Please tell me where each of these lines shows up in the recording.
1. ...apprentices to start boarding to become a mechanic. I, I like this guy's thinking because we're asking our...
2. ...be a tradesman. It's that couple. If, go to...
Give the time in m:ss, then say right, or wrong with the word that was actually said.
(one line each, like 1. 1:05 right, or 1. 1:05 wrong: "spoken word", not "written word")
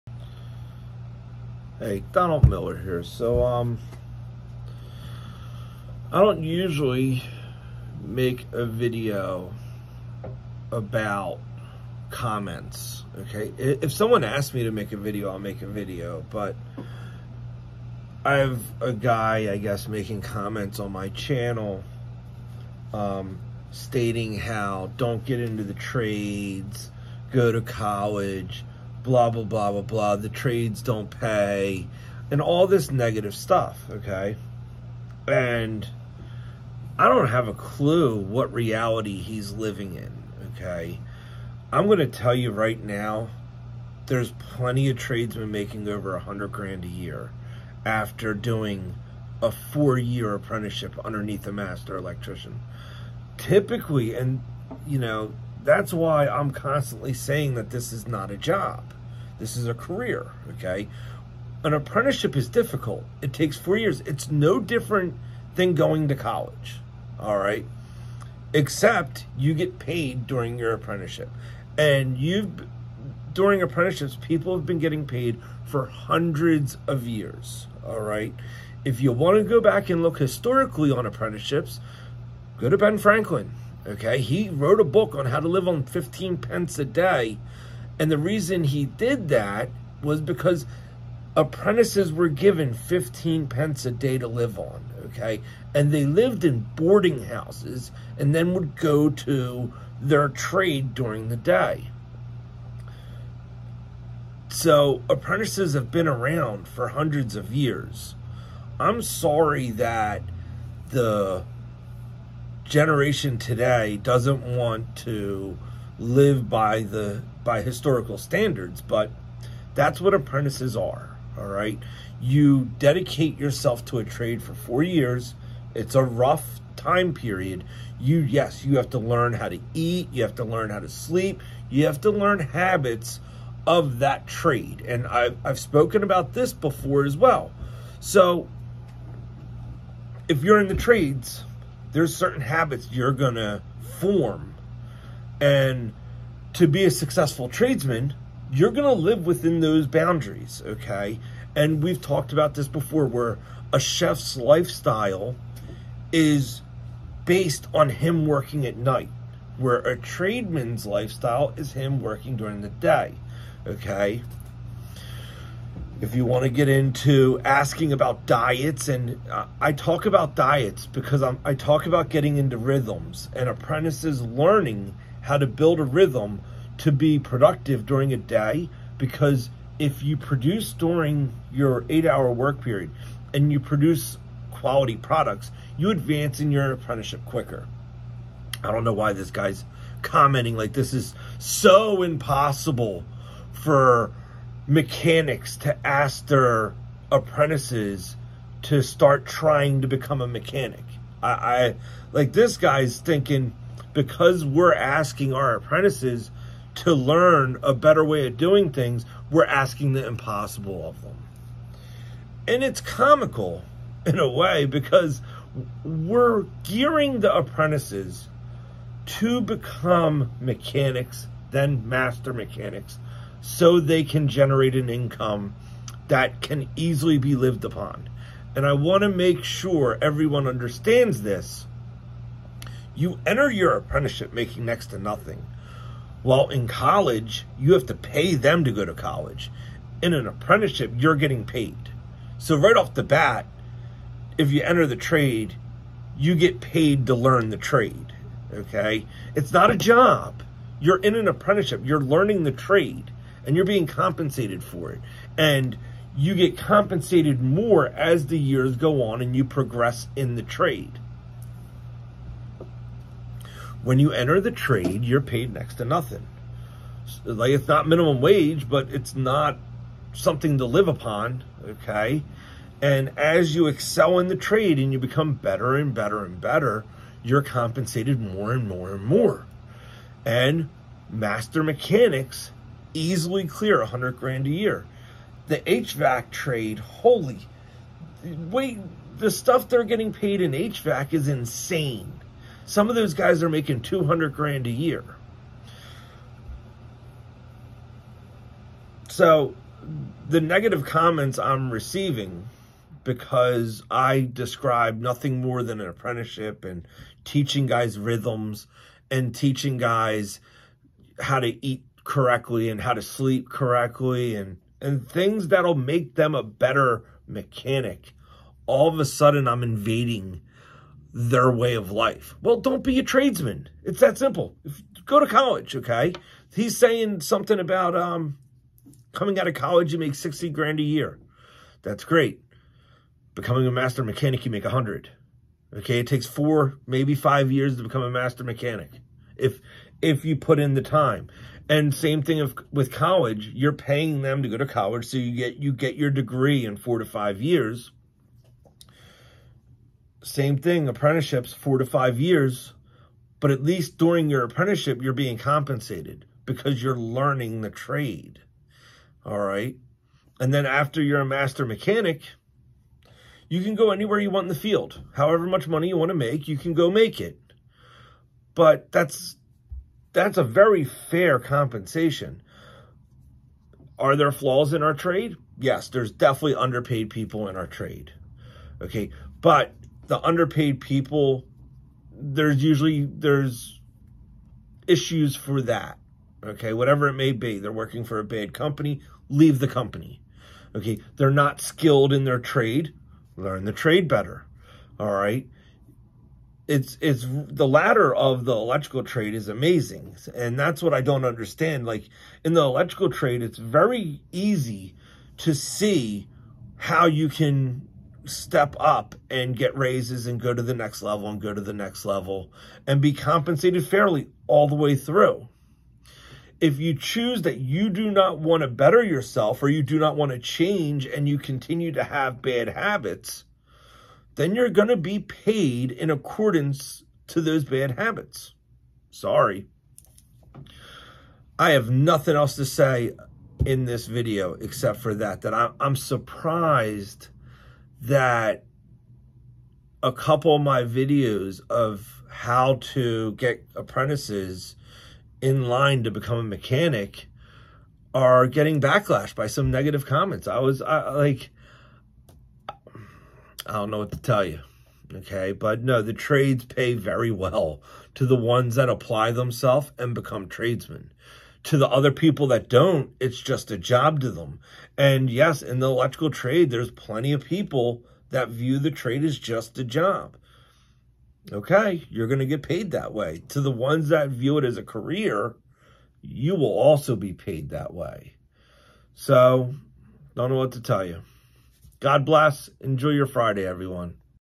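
1. 3:17 wrong: "trying", not "boarding"
2. 5:22 wrong: "simple", not "couple".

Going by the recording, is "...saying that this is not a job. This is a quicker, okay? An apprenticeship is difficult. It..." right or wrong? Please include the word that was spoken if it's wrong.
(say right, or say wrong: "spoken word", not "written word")
wrong: "career", not "quicker".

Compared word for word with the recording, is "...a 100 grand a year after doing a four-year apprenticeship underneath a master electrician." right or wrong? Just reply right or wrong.
right.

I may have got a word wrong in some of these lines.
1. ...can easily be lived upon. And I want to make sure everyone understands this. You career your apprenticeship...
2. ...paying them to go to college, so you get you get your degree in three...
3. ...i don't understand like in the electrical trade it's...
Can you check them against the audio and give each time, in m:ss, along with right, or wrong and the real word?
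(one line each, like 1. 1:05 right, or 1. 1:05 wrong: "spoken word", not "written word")
1. 3:46 wrong: "enter", not "career"
2. 5:43 wrong: "four", not "three"
3. 6:40 right.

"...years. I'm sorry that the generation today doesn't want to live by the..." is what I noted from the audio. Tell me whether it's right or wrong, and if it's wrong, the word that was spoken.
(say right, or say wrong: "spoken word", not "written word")
right.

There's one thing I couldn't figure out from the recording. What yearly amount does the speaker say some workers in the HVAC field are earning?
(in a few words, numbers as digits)
200 grand.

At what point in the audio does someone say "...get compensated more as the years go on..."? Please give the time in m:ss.
4:16.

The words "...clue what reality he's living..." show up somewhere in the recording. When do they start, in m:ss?
0:37.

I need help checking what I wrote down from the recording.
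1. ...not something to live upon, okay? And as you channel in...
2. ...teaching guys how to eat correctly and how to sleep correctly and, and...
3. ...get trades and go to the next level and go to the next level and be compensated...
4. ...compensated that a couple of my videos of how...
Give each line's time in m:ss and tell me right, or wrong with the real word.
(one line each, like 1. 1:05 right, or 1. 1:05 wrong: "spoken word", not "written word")
1. 4:29 wrong: "excel", not "channel"
2. 5:09 right
3. 6:49 wrong: "raises", not "trades"
4. 7:15 wrong: "surprised", not "compensated".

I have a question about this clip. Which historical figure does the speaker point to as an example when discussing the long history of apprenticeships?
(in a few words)
Ben Franklin.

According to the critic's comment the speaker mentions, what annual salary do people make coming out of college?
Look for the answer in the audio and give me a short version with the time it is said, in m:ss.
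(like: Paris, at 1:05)
60 grand, at 5:30.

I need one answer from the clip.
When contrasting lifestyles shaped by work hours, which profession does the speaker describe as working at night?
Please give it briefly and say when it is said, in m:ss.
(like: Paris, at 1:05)
chef, at 2:33.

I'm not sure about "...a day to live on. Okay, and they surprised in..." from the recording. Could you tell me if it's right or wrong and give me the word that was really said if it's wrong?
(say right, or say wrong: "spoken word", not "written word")
wrong: "lived", not "surprised".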